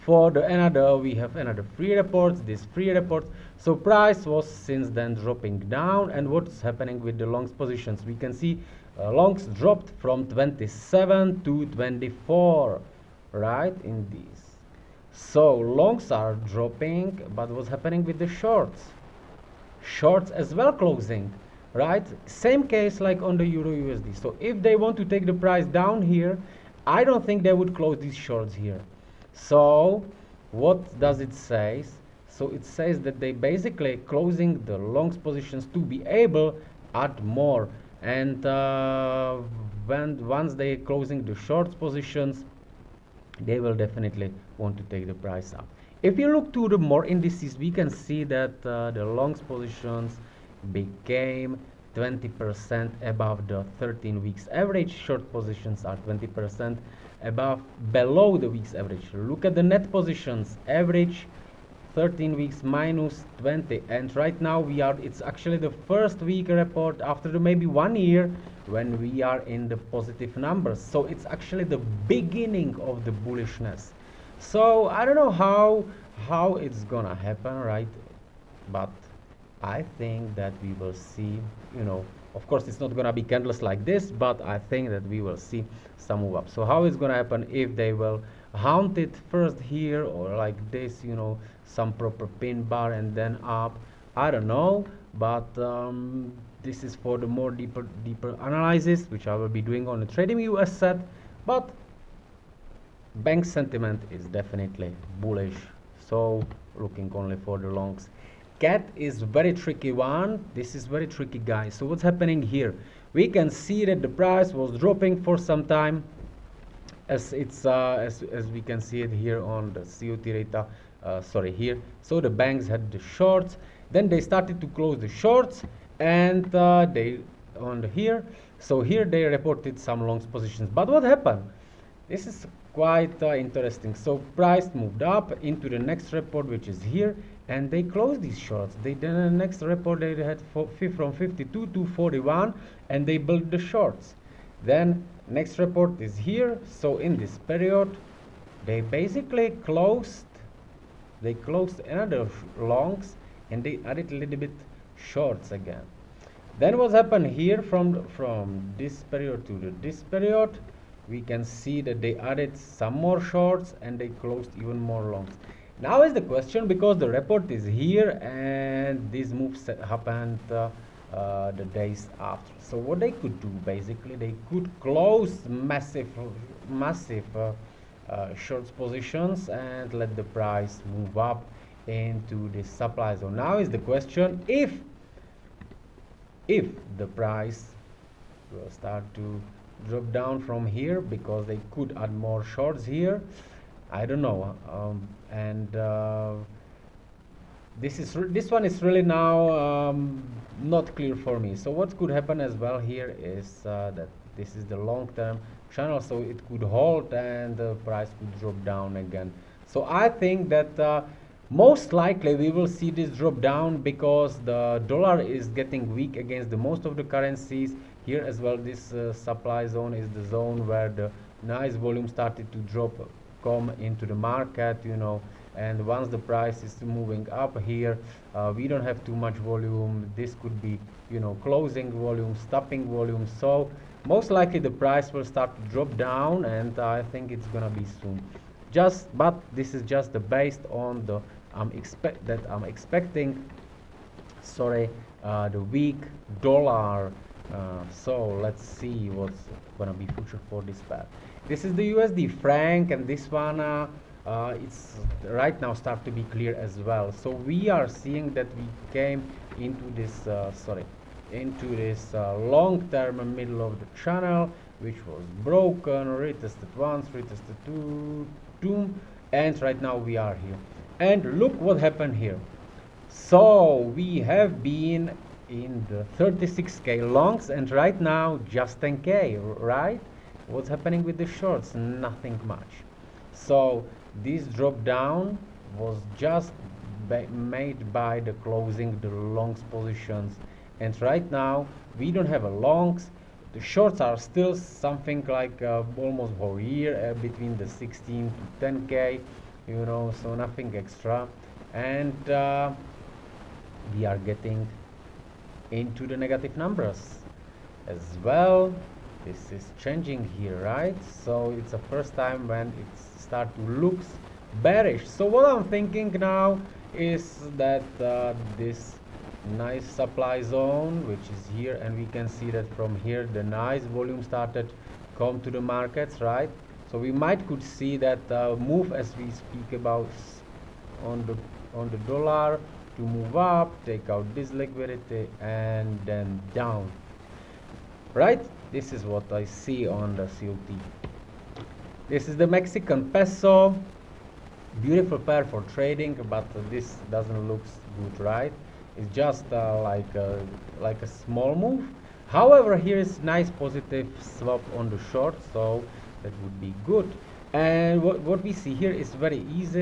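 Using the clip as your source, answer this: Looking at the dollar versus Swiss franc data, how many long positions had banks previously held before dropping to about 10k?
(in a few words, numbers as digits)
36k.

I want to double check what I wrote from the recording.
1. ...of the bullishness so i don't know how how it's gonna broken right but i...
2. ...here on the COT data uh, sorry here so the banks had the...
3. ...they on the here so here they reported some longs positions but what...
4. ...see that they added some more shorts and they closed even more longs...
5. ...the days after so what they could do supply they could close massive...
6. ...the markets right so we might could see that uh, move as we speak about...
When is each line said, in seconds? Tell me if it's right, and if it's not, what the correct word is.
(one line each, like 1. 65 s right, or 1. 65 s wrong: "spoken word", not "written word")
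1. 72 s wrong: "happen", not "broken"
2. 119 s right
3. 126 s right
4. 161 s right
5. 171 s wrong: "basically", not "supply"
6. 325 s right.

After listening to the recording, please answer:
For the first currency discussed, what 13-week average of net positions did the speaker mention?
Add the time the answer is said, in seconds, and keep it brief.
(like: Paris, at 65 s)
-20, at 62 s.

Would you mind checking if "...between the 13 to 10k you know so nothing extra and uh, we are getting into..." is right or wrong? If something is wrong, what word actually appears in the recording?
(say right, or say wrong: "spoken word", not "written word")
wrong: "16", not "13".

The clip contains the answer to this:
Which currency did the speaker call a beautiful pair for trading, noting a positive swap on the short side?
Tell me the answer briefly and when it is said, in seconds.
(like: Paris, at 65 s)
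Mexican peso, at 342 s.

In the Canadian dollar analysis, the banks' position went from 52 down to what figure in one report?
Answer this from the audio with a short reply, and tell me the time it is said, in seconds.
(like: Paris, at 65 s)
41, at 141 s.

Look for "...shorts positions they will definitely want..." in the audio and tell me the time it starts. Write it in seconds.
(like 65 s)
41 s.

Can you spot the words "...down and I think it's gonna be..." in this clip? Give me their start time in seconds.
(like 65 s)
235 s.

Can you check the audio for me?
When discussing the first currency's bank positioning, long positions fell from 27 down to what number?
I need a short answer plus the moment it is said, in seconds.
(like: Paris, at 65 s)
24, at 11 s.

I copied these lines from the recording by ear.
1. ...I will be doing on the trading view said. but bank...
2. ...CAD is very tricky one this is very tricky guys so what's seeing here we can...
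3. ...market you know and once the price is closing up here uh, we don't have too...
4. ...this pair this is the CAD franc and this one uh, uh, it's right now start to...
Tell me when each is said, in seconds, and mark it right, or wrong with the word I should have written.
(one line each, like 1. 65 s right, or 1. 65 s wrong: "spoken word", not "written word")
1. 99 s right
2. 108 s wrong: "happening", not "seeing"
3. 224 s wrong: "moving", not "closing"
4. 250 s wrong: "USD", not "CAD".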